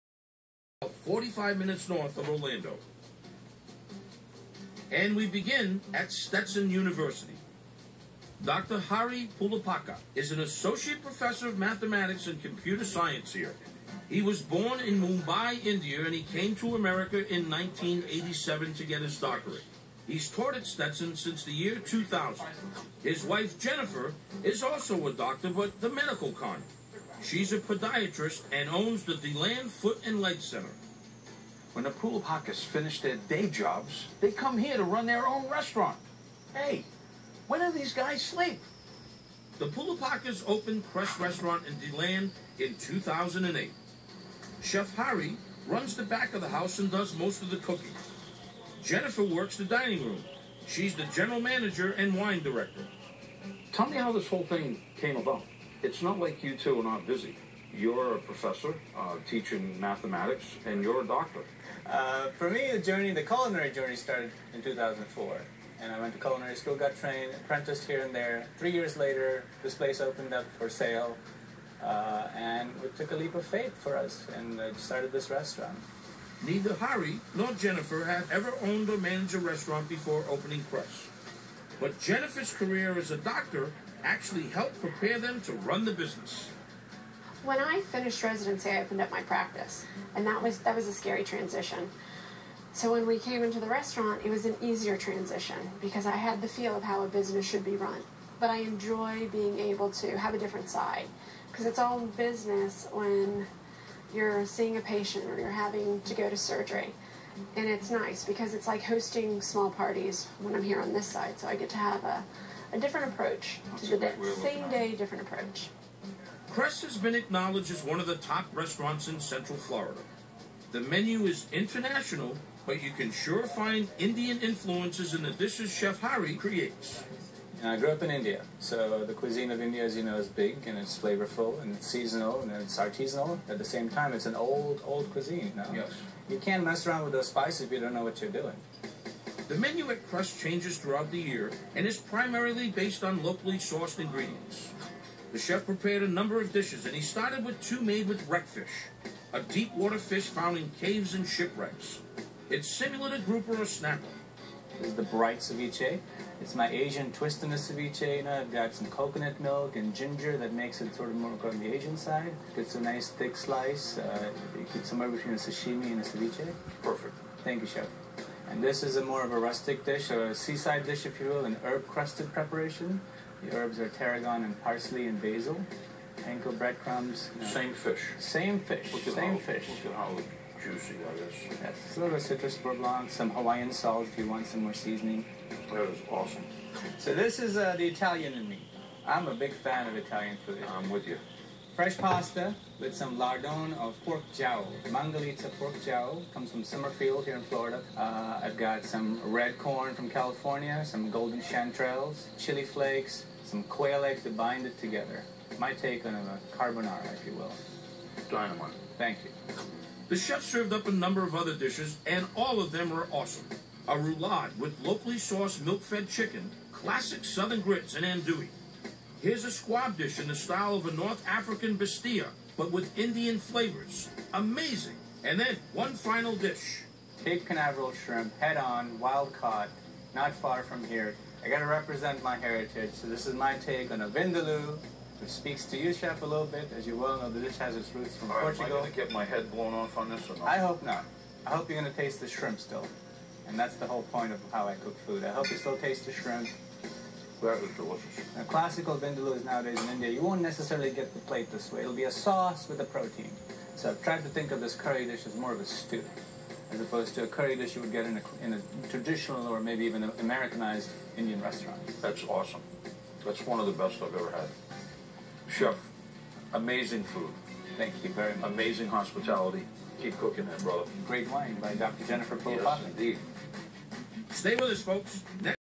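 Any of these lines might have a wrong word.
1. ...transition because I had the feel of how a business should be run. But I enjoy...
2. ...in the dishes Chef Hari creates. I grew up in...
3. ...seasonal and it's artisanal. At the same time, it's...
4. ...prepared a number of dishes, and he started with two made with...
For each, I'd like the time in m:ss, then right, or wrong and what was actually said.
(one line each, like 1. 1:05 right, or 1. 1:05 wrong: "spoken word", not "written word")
1. 1:34 right
2. 2:05 right
3. 2:11 right
4. 2:25 right.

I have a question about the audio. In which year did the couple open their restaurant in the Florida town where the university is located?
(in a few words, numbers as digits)
2008.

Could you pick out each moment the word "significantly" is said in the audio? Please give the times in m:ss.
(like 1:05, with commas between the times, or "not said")
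not said.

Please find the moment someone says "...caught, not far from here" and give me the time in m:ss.
3:49.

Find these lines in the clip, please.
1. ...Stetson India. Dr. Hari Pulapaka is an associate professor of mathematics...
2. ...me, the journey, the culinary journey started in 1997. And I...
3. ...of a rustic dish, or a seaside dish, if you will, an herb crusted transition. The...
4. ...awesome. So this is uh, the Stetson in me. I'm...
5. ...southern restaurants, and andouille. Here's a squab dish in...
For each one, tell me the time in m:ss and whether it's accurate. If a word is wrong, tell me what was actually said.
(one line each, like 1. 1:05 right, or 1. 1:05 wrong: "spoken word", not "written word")
1. 0:06 wrong: "University", not "India"
2. 1:02 wrong: "2004", not "1997"
3. 2:49 wrong: "preparation", not "transition"
4. 3:06 wrong: "Italian", not "Stetson"
5. 3:37 wrong: "grits", not "restaurants".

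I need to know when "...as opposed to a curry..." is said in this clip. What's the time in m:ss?
4:16.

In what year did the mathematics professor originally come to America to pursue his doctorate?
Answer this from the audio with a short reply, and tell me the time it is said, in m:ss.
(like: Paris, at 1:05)
1987, at 0:17.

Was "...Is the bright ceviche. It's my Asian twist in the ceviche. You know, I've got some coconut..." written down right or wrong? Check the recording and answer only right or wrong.
right.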